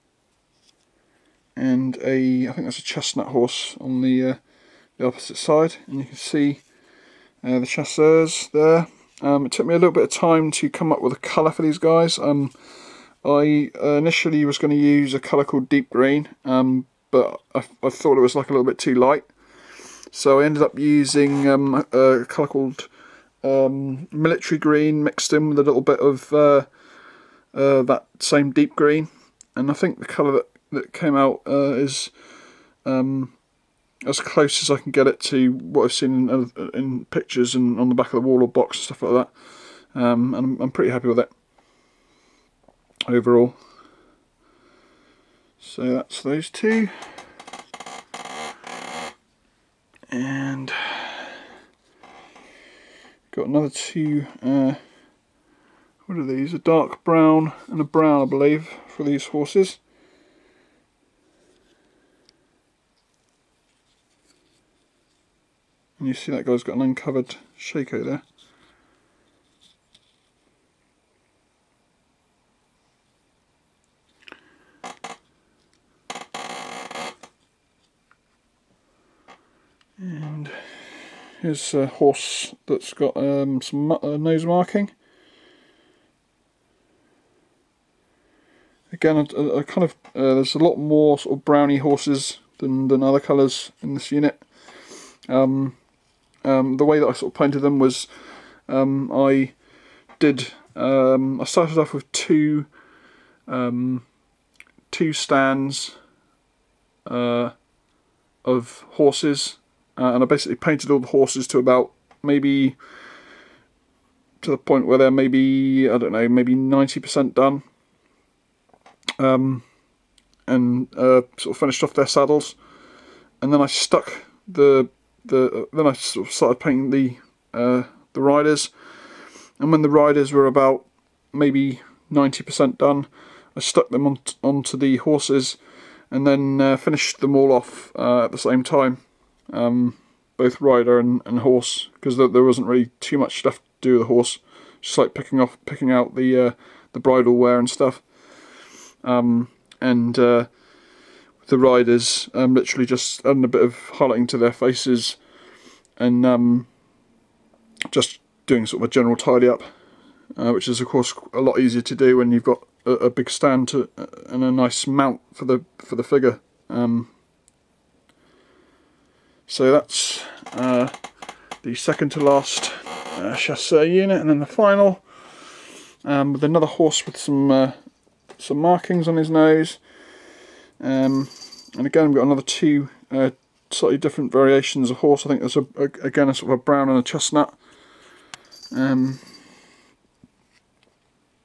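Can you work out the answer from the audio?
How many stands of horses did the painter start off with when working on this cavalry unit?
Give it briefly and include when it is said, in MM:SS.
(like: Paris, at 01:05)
2, at 01:44.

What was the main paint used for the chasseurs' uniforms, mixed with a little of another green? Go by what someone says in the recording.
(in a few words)
Military Green.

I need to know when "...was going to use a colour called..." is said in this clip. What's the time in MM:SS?
00:14.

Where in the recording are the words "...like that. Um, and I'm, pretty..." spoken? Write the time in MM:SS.
00:39.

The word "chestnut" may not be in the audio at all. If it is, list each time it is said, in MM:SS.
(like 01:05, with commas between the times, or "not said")
00:02, 03:07.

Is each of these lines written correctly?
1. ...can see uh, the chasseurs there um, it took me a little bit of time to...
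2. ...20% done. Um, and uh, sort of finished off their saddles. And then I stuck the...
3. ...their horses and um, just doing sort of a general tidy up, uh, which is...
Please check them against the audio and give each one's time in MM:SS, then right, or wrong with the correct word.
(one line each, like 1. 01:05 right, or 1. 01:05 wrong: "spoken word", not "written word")
1. 00:06 right
2. 01:56 wrong: "90", not "20"
3. 02:34 wrong: "faces", not "horses".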